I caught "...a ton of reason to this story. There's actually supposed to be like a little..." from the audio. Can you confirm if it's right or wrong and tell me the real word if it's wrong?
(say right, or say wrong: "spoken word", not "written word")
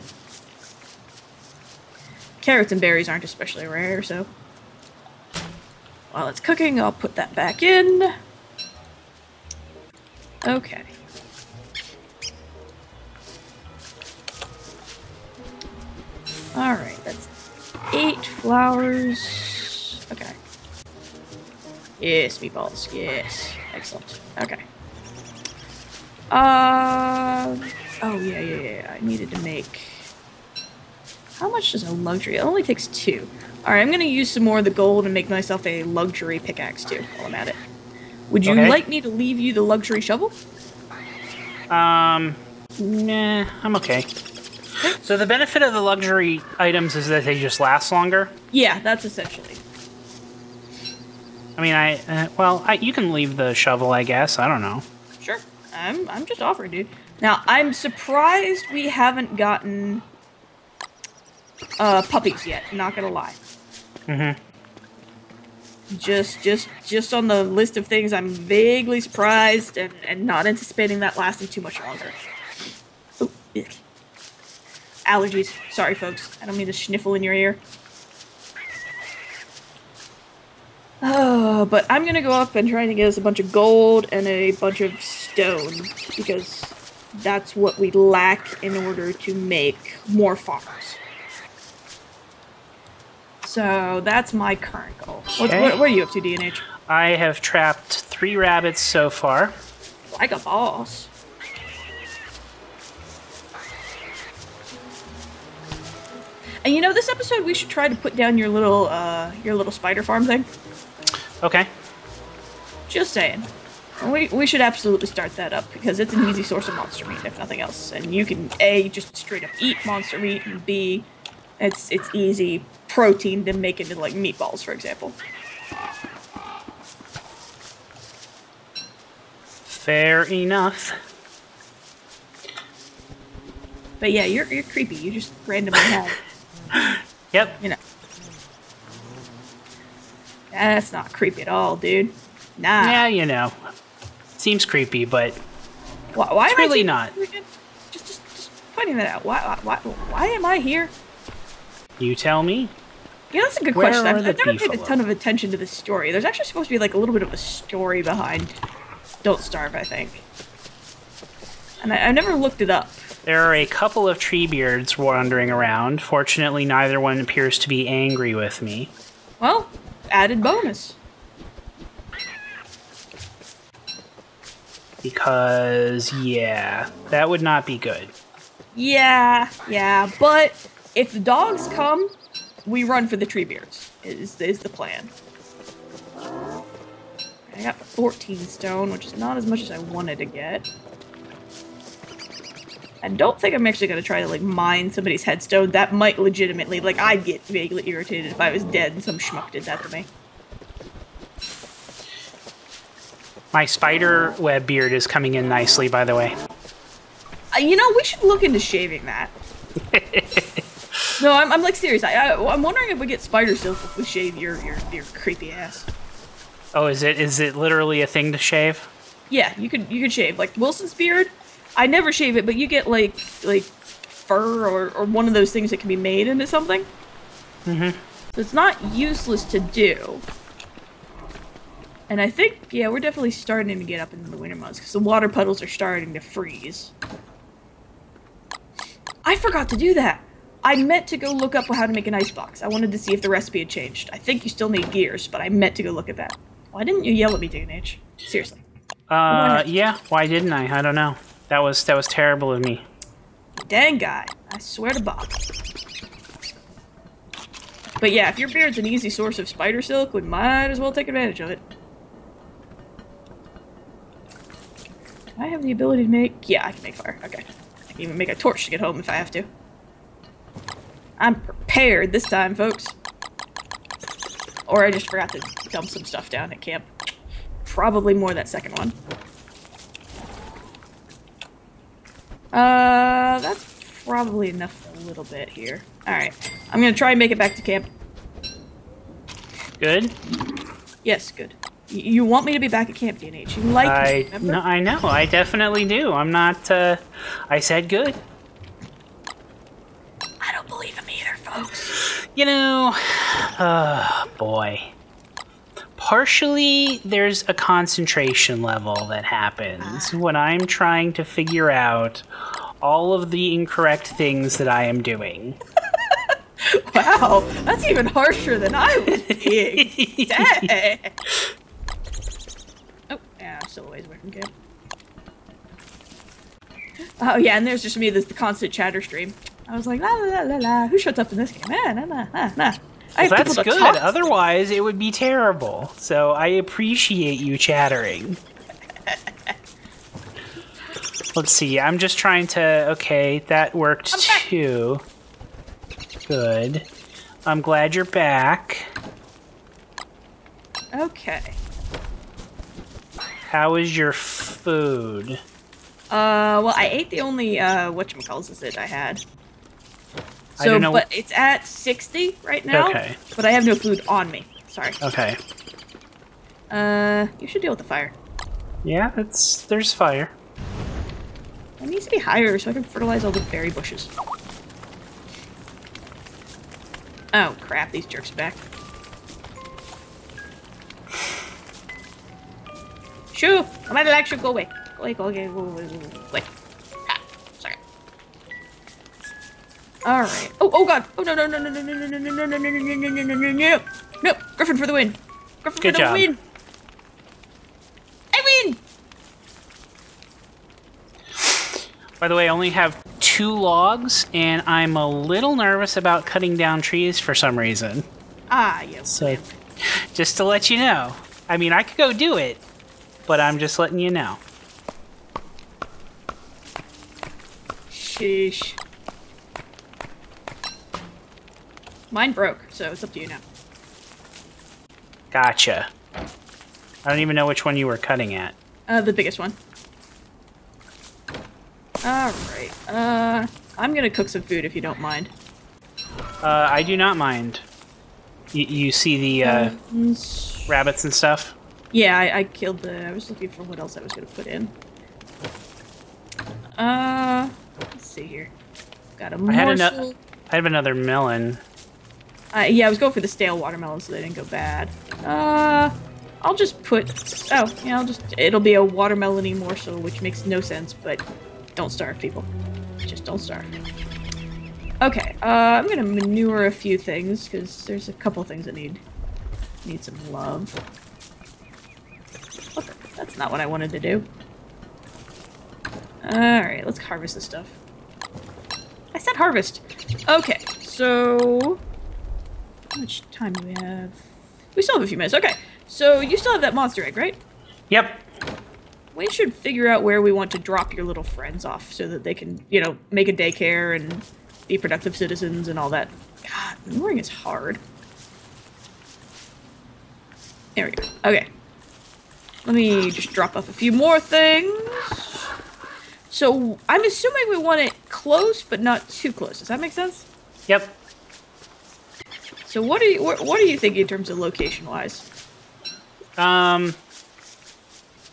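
wrong: "attention", not "reason".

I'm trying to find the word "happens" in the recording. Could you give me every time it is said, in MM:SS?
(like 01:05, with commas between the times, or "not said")
05:09.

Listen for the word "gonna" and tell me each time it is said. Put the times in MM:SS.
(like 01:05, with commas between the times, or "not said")
01:02, 01:22, 03:13, 04:46, 07:13, 07:24, 07:45.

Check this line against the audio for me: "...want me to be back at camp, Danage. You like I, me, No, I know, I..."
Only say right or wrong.
wrong.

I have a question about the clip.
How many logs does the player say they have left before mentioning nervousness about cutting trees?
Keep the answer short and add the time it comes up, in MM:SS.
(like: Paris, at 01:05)
2, at 06:43.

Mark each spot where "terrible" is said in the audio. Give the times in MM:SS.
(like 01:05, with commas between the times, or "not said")
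04:12, 05:35.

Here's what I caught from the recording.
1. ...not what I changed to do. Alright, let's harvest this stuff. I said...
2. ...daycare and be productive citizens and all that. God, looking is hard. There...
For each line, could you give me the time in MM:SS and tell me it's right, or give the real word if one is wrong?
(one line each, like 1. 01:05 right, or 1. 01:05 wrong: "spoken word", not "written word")
1. 07:53 wrong: "wanted", not "changed"
2. 08:13 wrong: "mooring", not "looking".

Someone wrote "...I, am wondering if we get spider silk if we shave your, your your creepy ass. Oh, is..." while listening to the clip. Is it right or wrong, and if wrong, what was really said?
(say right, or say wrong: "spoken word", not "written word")
right.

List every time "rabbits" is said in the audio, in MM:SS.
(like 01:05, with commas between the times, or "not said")
01:38, 07:20.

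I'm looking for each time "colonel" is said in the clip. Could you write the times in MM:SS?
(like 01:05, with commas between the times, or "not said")
not said.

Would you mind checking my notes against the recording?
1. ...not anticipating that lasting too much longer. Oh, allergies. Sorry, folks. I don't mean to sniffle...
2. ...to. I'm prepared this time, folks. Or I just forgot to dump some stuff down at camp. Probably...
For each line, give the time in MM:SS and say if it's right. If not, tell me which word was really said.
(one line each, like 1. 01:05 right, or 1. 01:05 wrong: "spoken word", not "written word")
1. 01:10 right
2. 04:29 right.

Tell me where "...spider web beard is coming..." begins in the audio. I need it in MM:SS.
03:23.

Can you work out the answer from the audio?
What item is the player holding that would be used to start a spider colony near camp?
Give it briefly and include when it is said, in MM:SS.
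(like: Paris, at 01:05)
monster egg, at 08:06.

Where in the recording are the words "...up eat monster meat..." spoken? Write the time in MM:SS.
01:59.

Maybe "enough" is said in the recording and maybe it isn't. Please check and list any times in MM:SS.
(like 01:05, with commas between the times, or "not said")
02:10, 04:44.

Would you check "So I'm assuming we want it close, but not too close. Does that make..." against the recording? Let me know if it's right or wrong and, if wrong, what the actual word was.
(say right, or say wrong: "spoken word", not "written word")
right.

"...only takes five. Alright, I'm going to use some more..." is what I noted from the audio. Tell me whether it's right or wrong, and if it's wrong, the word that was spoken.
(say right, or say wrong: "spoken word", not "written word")
wrong: "two", not "five".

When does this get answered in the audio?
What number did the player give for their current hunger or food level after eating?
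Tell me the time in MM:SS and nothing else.
06:01.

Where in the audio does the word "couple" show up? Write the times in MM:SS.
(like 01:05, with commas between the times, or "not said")
02:43, 07:48.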